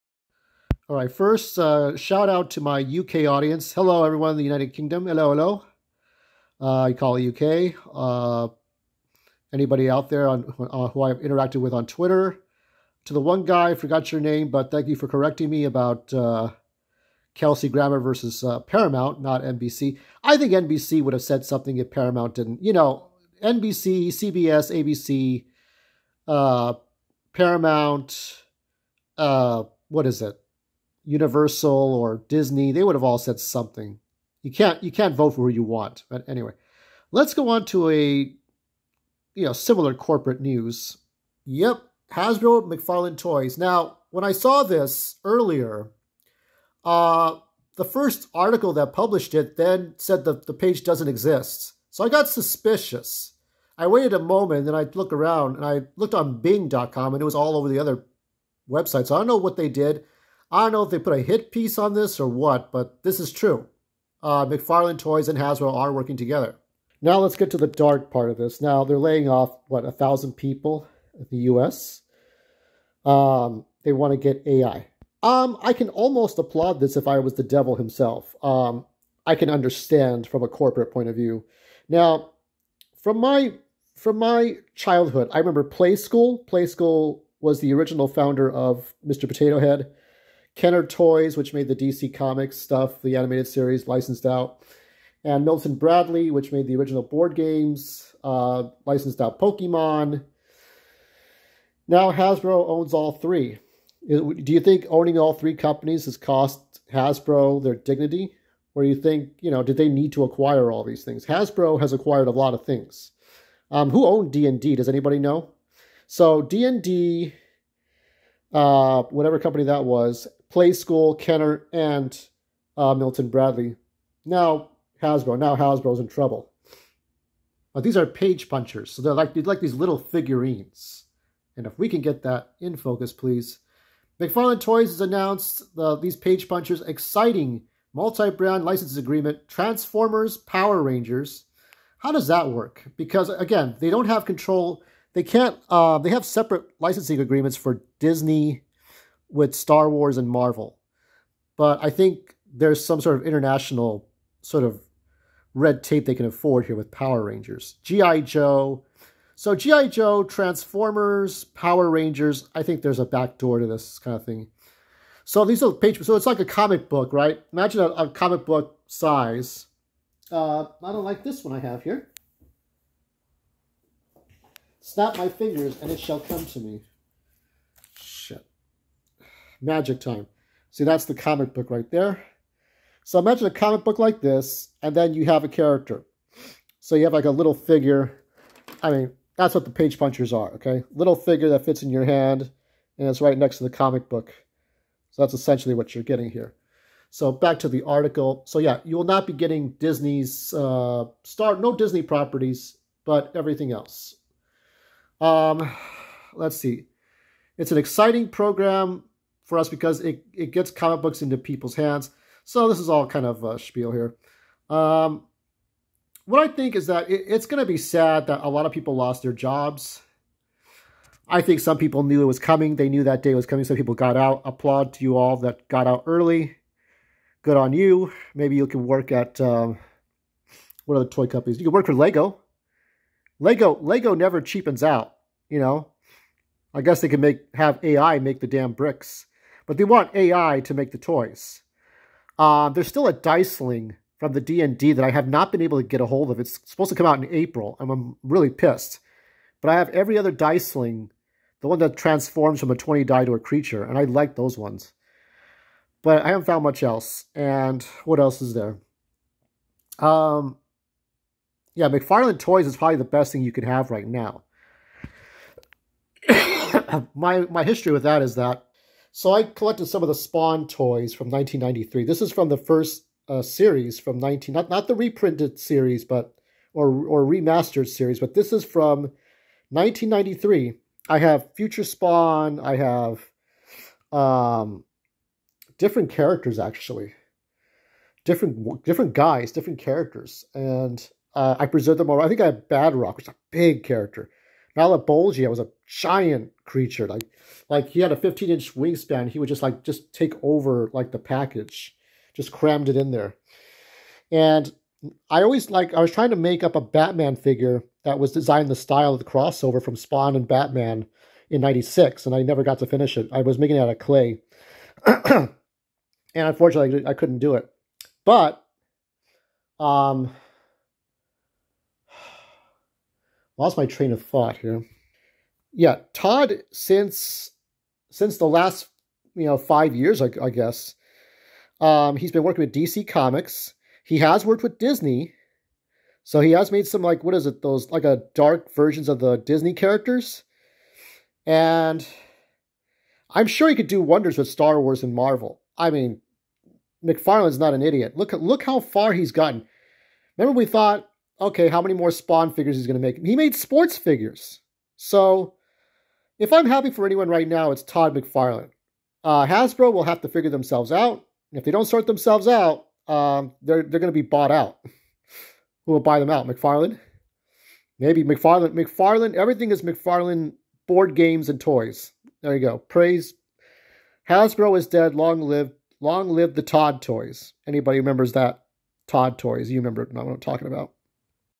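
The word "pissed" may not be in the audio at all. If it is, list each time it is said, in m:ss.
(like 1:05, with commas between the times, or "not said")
4:08.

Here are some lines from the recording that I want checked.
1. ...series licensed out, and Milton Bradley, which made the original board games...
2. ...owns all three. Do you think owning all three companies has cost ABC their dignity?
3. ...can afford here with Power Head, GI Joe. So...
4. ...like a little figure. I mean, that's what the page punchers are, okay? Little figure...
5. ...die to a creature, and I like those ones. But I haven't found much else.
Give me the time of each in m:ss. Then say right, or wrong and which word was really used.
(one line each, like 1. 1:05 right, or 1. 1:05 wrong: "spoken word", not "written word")
1. 1:33 right
2. 1:42 wrong: "Hasbro", not "ABC"
3. 2:36 wrong: "Rangers", not "Head"
4. 3:07 right
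5. 4:13 right.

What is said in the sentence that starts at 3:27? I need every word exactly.
It's an exciting program for us because it, it gets comic books into people's hands.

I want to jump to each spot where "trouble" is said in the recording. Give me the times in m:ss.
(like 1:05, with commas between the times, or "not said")
2:06.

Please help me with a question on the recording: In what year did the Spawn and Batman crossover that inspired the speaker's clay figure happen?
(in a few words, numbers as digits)
1996.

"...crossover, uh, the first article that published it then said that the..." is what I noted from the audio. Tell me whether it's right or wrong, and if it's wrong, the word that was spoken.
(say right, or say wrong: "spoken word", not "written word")
wrong: "earlier", not "crossover".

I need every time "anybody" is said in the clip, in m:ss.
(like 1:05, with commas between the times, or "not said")
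0:09, 1:54, 6:17.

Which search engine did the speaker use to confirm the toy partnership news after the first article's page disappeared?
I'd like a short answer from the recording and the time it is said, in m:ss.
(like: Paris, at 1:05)
Bing.com, at 0:56.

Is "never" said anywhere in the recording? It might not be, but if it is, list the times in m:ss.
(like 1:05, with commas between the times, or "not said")
3:54, 5:12.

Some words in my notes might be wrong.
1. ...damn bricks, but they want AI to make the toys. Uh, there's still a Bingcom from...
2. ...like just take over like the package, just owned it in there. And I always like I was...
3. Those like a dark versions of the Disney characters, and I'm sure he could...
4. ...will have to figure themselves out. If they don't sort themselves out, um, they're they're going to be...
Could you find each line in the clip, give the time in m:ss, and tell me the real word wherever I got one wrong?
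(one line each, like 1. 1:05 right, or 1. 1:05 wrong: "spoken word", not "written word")
1. 3:58 wrong: "Diceling", not "Bingcom"
2. 4:59 wrong: "crammed", not "owned"
3. 5:37 right
4. 5:59 right.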